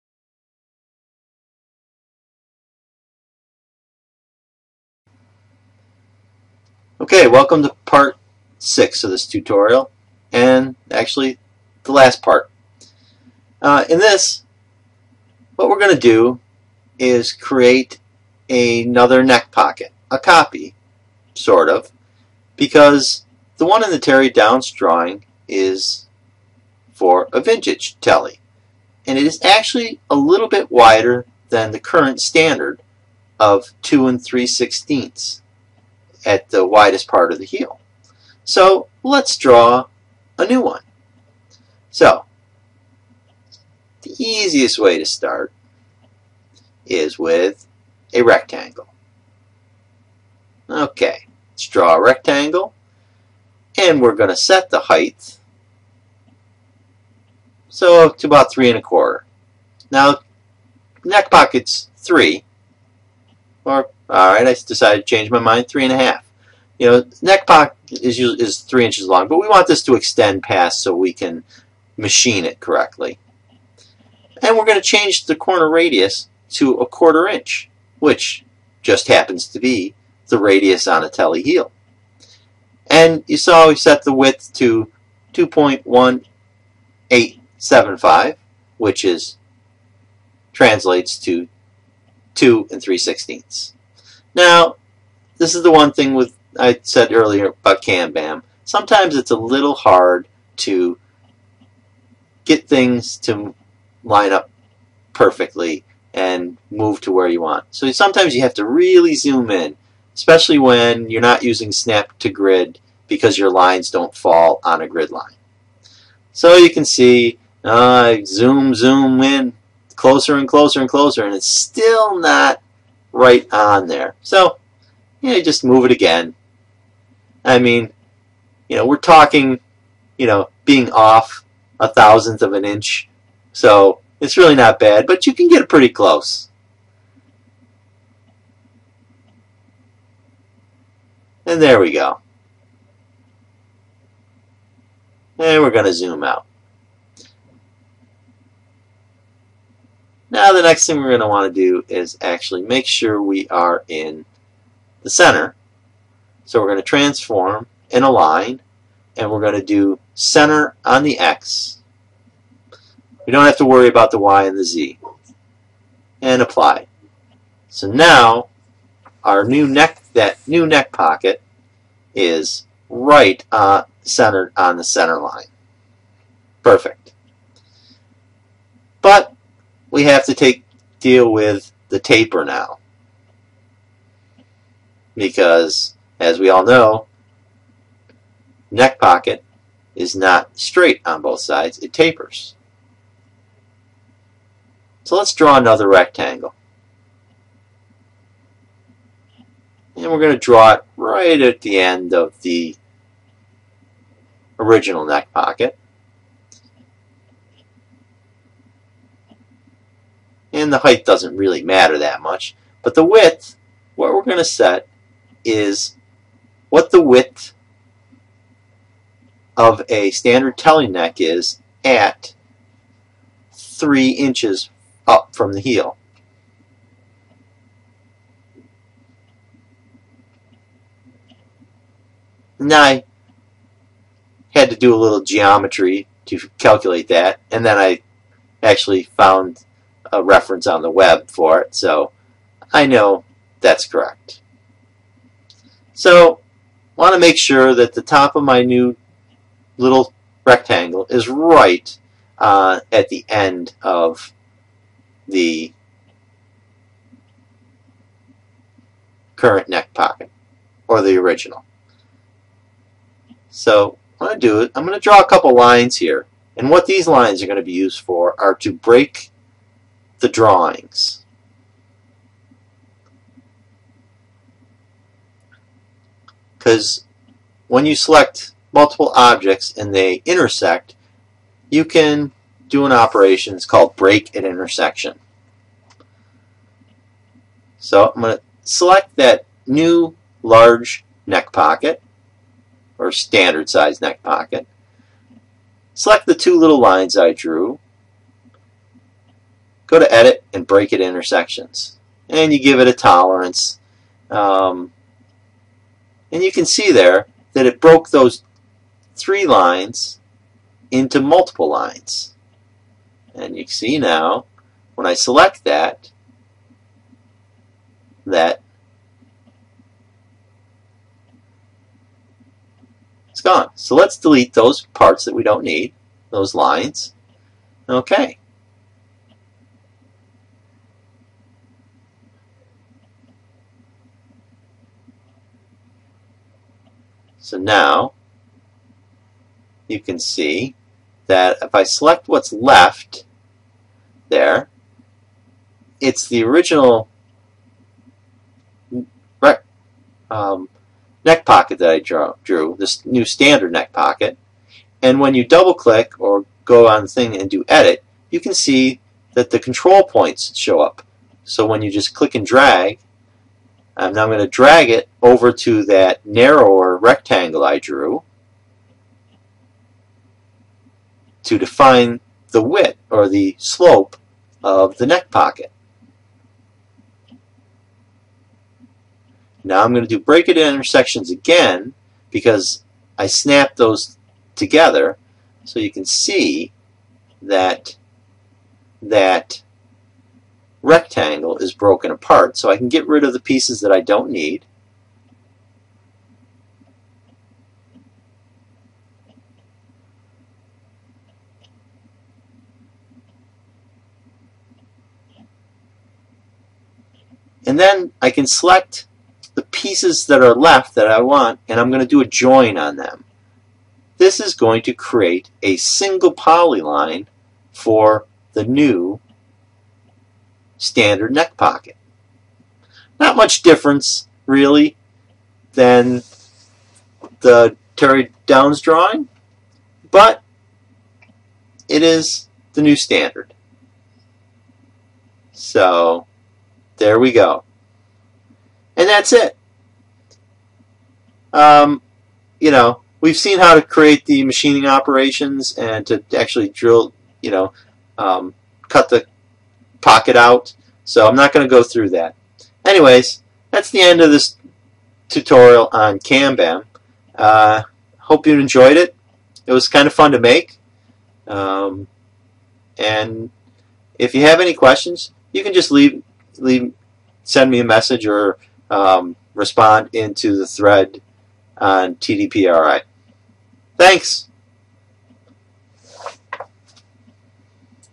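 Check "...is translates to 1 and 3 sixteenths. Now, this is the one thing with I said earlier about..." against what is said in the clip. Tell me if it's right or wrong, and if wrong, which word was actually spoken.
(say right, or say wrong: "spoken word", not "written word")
wrong: "2", not "1".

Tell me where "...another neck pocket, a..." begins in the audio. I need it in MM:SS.
00:18.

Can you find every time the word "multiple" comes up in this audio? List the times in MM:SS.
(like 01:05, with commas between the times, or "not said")
04:38, 05:11.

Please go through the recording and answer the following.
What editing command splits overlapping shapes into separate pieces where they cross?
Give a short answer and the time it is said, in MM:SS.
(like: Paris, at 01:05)
Break at intersection, at 04:43.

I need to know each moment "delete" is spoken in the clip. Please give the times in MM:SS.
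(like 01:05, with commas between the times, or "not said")
05:24.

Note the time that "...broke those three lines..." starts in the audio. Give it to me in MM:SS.
05:07.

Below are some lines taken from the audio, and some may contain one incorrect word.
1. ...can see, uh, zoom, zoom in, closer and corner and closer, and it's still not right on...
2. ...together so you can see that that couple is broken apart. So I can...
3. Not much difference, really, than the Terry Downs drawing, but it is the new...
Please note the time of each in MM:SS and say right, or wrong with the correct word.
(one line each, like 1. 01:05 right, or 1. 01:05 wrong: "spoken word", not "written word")
1. 01:56 wrong: "closer", not "corner"
2. 06:24 wrong: "rectangle", not "couple"
3. 07:03 right.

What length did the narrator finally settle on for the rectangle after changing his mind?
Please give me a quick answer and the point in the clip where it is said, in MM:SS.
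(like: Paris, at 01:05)
3.5, at 01:05.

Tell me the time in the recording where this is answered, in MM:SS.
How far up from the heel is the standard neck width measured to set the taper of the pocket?
03:43.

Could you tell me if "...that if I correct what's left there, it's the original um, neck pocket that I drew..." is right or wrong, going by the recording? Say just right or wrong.
wrong.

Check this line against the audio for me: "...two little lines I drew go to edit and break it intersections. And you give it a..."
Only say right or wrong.
right.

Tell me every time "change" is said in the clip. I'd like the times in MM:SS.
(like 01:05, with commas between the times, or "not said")
01:05, 01:14.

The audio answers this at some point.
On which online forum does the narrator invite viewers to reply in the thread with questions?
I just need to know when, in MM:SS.
07:52.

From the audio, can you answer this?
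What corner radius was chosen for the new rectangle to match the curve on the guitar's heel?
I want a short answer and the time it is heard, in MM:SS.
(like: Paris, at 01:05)
1/4 inch, at 01:16.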